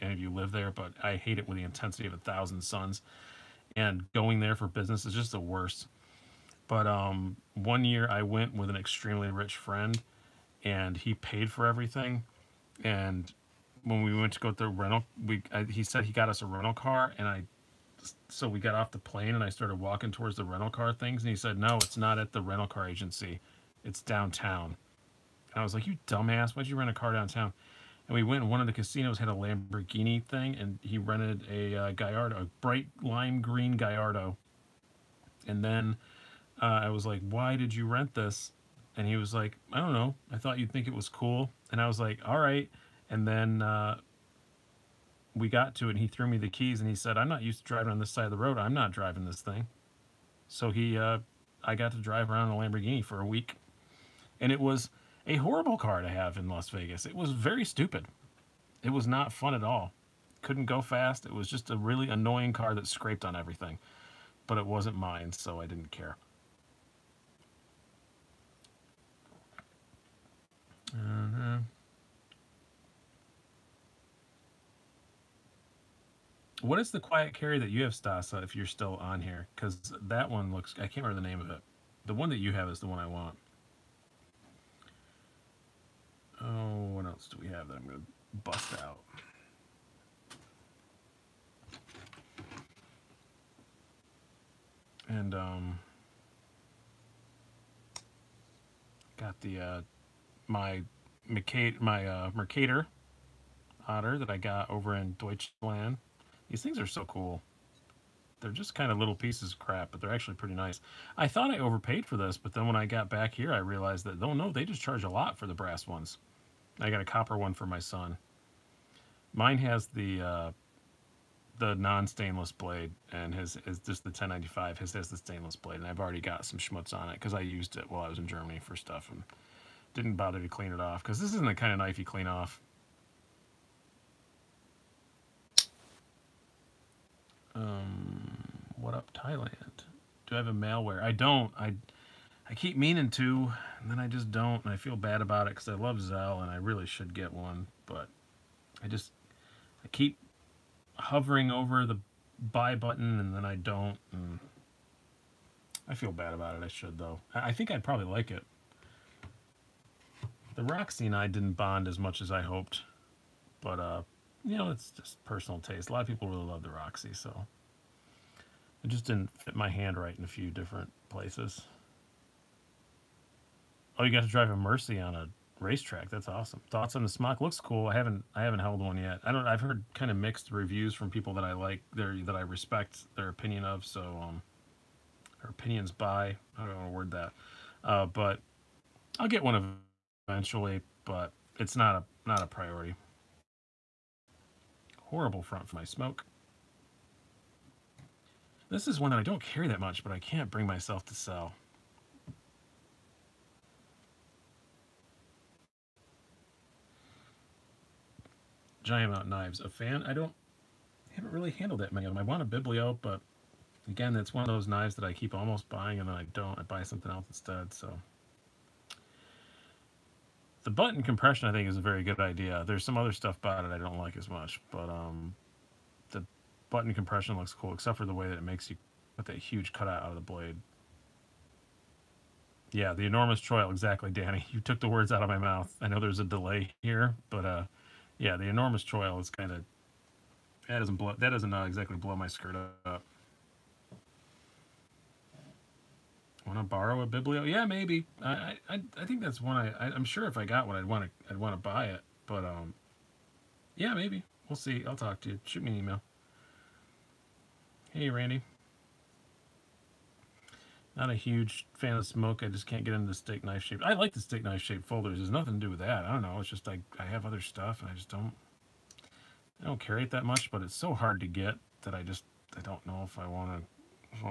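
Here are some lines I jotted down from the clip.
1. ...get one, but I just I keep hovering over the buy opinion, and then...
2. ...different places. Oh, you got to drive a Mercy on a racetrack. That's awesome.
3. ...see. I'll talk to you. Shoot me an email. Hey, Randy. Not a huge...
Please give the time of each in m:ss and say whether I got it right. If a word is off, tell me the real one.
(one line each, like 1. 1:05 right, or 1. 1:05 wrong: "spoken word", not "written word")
1. 2:27 wrong: "button", not "opinion"
2. 2:50 right
3. 4:14 right.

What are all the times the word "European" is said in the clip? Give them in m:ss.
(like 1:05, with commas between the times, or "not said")
not said.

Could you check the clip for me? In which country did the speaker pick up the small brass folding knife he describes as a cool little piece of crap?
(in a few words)
Germany.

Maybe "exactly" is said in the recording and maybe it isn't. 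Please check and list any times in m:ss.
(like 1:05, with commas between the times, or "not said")
3:53, 4:01.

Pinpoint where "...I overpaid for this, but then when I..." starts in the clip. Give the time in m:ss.
1:51.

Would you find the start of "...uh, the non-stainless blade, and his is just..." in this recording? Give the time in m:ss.
2:00.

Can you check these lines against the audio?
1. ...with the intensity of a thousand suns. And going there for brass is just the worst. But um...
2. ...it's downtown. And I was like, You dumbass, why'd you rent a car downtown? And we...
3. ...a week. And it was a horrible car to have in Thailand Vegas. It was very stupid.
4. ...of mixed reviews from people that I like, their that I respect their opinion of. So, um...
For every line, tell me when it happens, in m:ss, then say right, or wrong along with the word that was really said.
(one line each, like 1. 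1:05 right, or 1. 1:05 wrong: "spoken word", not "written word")
1. 0:01 wrong: "business", not "brass"
2. 0:23 right
3. 0:53 wrong: "Las", not "Thailand"
4. 3:00 right.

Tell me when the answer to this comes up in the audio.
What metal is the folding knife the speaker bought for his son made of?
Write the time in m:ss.
1:57.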